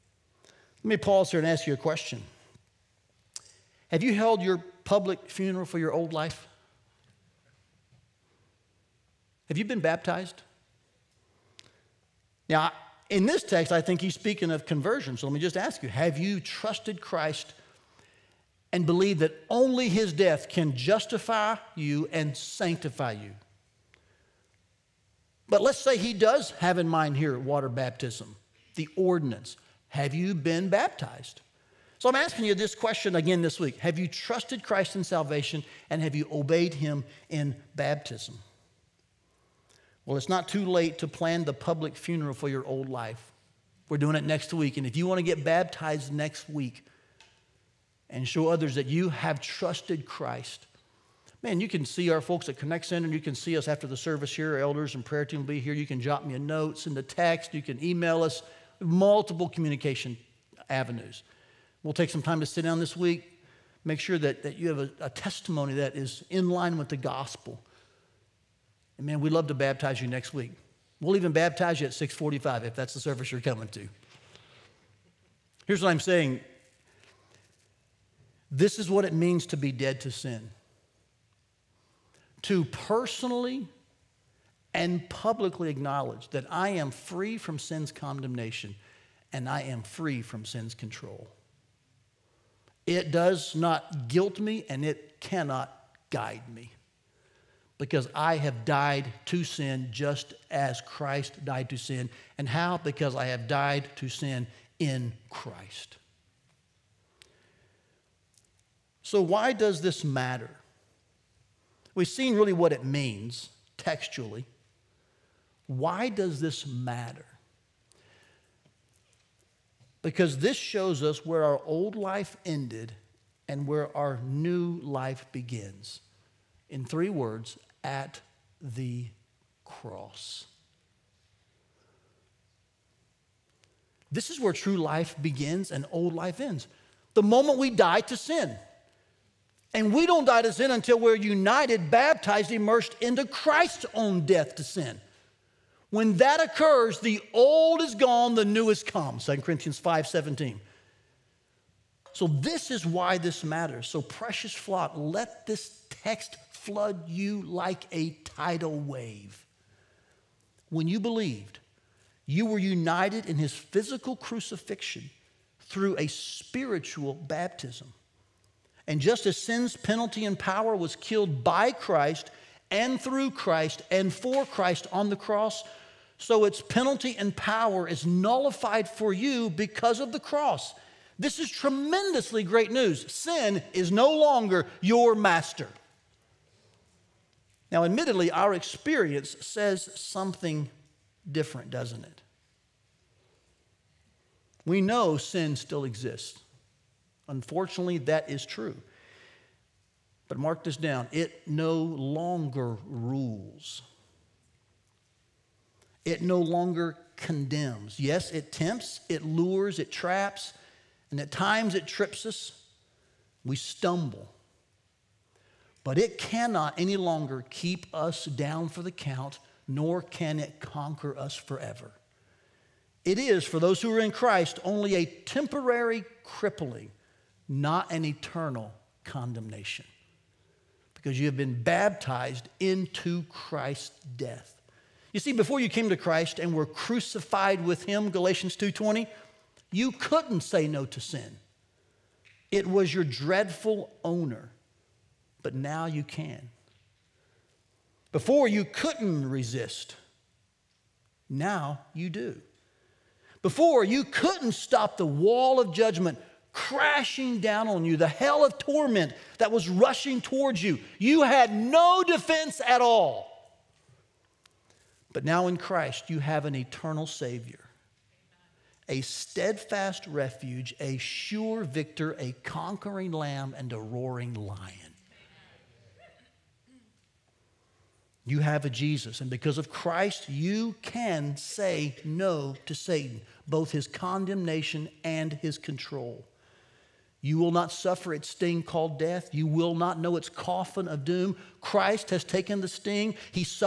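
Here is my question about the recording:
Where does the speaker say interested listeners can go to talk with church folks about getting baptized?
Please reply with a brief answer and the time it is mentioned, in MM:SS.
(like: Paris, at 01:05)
Connect Center, at 00:52.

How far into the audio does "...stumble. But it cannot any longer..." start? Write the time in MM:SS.
03:33.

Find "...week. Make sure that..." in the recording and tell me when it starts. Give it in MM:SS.
01:02.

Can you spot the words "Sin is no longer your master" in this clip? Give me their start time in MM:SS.
03:03.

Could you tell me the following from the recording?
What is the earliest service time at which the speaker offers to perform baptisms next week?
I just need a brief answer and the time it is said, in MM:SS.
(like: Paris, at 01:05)
6:45, at 01:11.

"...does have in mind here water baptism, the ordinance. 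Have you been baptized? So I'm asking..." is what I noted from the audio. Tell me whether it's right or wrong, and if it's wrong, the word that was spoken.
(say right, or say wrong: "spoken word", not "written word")
right.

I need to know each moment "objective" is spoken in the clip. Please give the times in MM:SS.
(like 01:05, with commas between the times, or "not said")
not said.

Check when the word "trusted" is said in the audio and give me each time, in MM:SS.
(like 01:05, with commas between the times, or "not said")
00:16, 00:34, 00:49.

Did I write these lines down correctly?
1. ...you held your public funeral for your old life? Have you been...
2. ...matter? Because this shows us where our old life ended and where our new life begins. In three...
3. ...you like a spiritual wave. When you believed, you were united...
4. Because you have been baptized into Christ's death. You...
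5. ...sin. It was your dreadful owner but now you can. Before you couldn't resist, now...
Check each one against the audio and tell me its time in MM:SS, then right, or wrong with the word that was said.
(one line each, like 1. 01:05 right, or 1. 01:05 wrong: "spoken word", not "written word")
1. 00:04 right
2. 01:56 right
3. 02:37 wrong: "tidal", not "spiritual"
4. 03:50 right
5. 04:00 right.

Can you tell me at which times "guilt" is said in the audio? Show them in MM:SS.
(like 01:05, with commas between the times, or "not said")
01:34.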